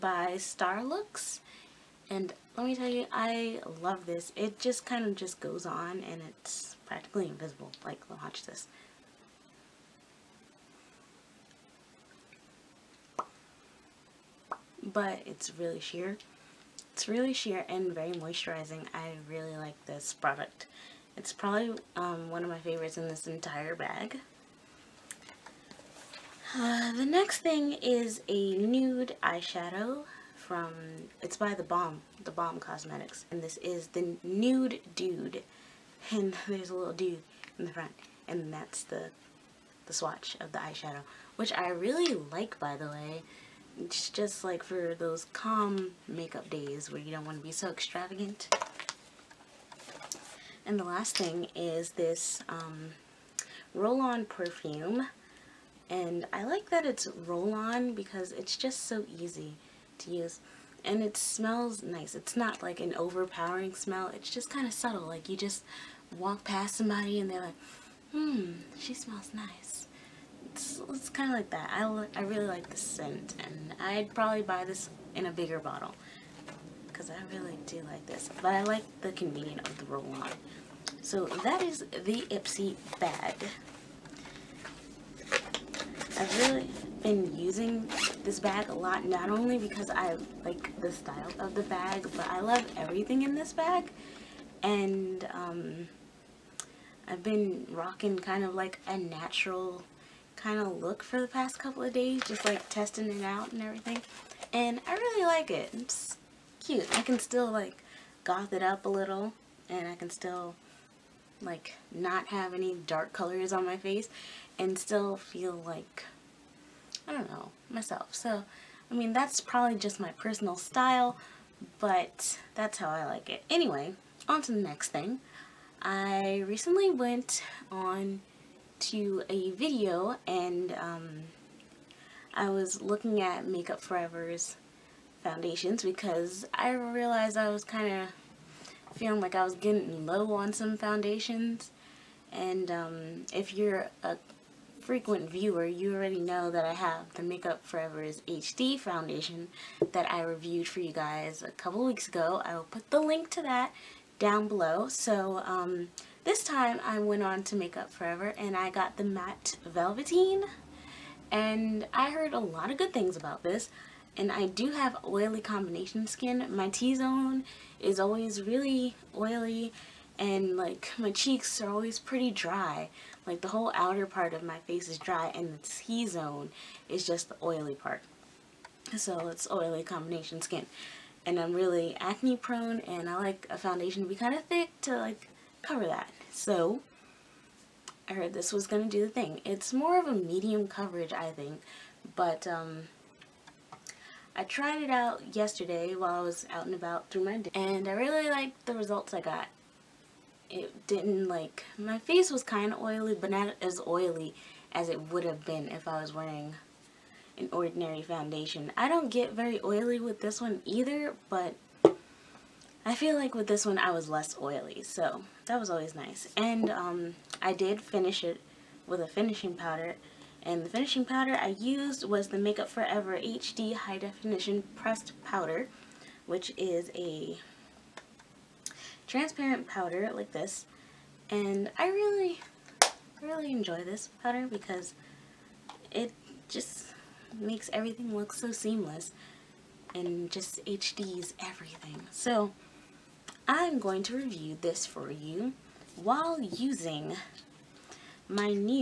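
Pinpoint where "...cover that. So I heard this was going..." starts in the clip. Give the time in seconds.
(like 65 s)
185 s.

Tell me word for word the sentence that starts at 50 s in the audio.
And the last thing is this um, roll-on perfume.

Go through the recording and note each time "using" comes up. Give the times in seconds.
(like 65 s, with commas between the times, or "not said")
87 s, 246 s.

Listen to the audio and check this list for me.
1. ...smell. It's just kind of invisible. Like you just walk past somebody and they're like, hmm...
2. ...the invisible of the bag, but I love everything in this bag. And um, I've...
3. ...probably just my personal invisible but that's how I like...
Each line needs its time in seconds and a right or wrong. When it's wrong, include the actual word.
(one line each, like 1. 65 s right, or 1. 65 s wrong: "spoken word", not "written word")
1. 63 s wrong: "subtle", not "invisible"
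2. 90 s wrong: "style", not "invisible"
3. 119 s wrong: "style", not "invisible".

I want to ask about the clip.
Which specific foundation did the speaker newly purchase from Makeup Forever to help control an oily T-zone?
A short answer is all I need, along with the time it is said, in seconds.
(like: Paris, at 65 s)
Matte Velveteen, at 159 s.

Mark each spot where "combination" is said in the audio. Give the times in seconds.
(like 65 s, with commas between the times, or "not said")
165 s, 179 s.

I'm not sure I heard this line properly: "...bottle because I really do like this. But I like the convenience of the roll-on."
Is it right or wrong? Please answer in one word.
right.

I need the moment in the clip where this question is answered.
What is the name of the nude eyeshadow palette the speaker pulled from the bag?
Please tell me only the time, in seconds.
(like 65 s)
34 s.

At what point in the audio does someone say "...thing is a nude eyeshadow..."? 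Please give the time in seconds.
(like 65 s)
27 s.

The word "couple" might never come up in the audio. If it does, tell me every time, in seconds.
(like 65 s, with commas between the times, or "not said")
101 s, 151 s.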